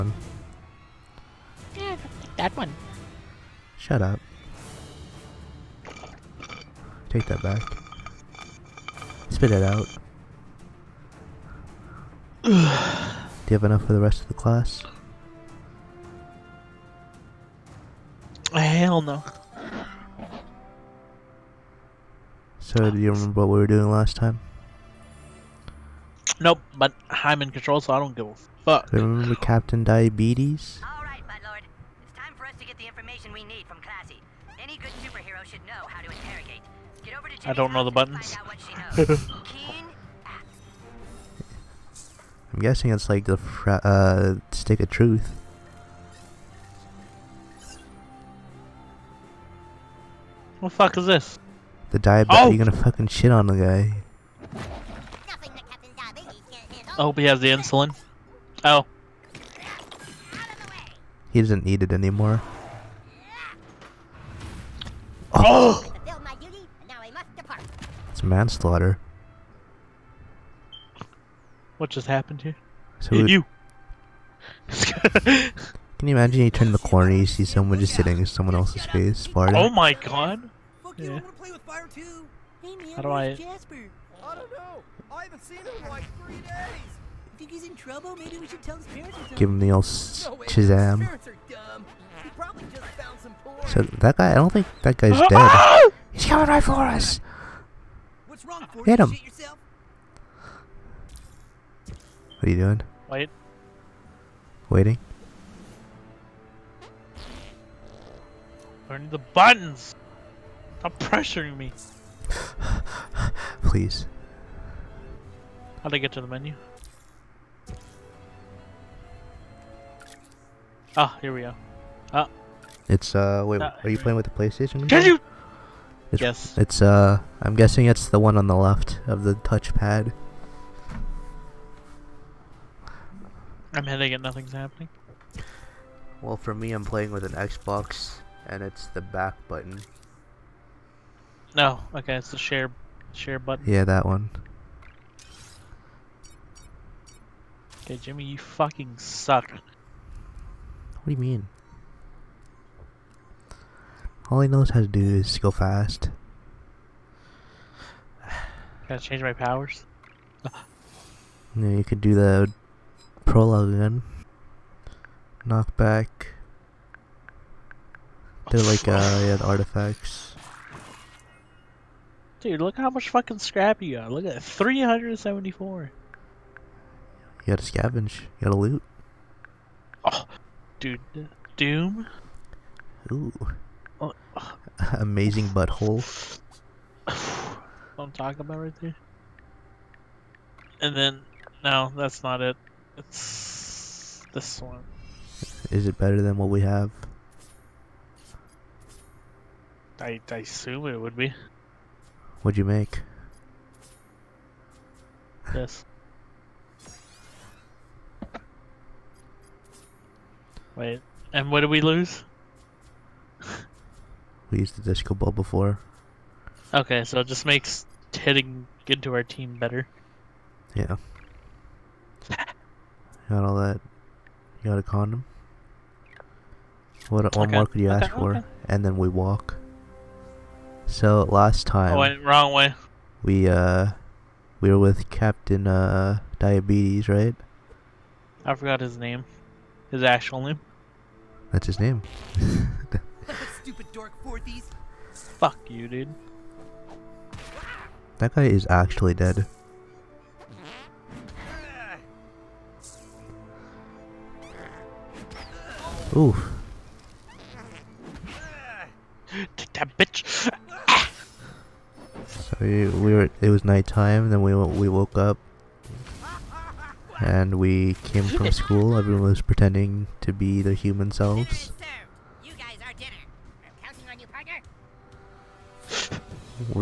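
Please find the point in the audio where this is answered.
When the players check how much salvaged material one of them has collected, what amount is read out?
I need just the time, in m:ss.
2:54.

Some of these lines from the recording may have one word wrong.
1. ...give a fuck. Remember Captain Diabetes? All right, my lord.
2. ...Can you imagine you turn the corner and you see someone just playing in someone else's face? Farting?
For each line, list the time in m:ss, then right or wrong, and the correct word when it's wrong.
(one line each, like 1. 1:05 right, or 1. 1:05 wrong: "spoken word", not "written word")
1. 0:28 right
2. 1:14 wrong: "sitting", not "playing".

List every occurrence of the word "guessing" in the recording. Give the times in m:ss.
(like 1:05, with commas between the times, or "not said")
0:42, 2:07.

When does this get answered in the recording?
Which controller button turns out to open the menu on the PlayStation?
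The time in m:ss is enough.
2:22.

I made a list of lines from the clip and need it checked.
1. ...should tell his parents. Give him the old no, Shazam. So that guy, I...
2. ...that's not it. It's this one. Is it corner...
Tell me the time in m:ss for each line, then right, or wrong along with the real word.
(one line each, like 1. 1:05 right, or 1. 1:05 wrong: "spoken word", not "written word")
1. 1:28 right
2. 3:11 wrong: "better", not "corner".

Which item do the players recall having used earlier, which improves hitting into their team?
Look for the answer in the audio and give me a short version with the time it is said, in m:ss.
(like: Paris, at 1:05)
disco ball, at 3:34.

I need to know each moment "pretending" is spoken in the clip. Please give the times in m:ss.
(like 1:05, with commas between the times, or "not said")
4:29.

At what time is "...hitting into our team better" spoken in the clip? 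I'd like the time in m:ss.
3:38.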